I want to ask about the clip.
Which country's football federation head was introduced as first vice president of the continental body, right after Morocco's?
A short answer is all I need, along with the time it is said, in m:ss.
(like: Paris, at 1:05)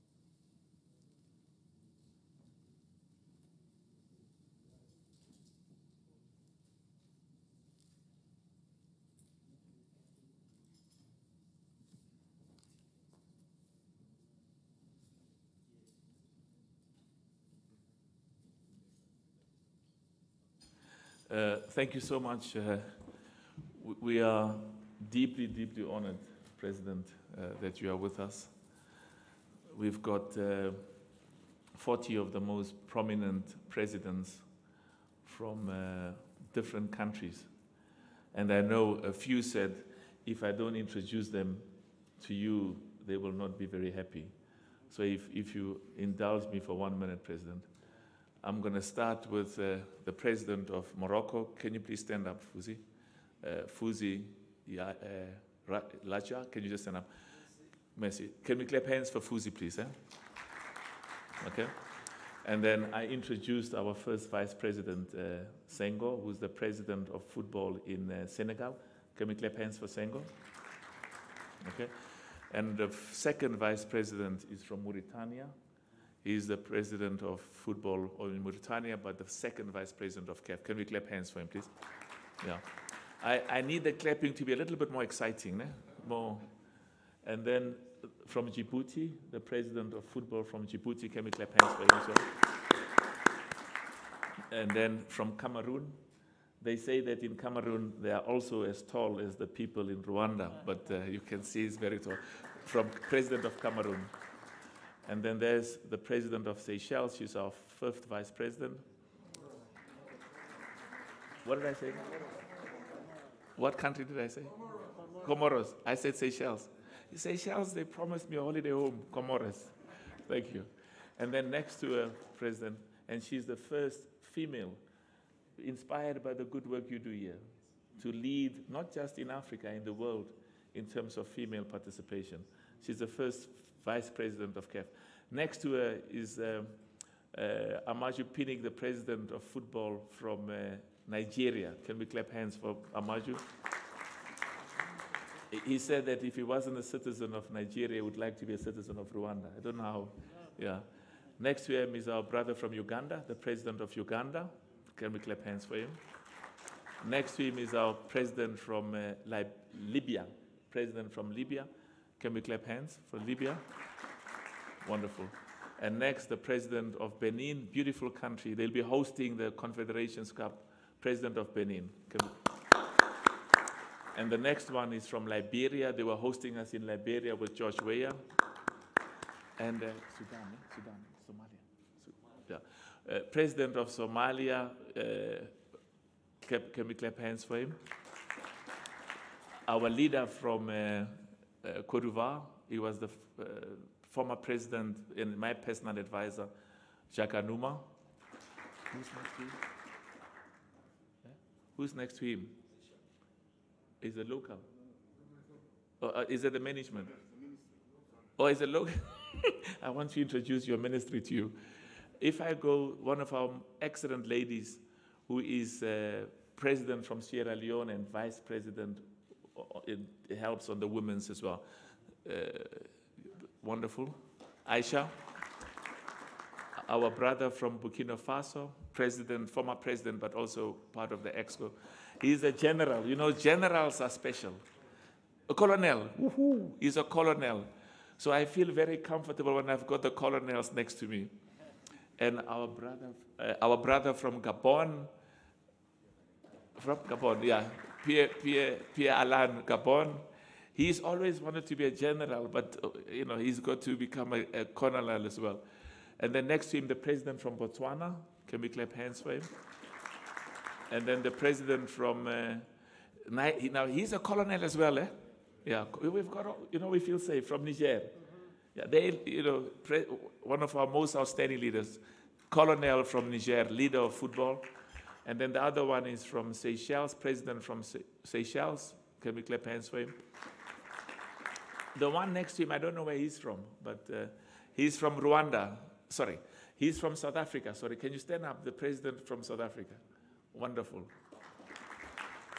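Senegal, at 1:08.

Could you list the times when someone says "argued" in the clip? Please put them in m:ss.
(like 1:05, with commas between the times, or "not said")
not said.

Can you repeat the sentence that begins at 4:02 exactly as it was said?
And our brother, uh, our brother from Gabon, from Gabon, yeah, Pierre, Pierre, Pierre Alain Gabon.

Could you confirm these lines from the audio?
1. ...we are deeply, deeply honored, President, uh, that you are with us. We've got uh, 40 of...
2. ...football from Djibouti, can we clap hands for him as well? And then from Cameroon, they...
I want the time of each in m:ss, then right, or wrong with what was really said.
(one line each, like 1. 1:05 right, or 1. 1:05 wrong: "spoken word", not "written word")
1. 0:23 right
2. 1:30 right.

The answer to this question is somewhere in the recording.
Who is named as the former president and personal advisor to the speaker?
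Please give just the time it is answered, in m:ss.
3:17.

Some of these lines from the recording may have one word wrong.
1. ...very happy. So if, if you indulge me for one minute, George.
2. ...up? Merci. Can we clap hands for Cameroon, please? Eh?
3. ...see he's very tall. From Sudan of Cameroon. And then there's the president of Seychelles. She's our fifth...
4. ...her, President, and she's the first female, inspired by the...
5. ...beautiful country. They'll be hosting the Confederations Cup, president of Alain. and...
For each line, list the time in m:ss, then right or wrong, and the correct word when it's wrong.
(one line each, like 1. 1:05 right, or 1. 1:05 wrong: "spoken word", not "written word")
1. 0:43 wrong: "President", not "George"
2. 0:56 wrong: "Fuzi", not "Cameroon"
3. 1:41 wrong: "President", not "Sudan"
4. 2:01 right
5. 2:47 wrong: "Benin", not "Alain".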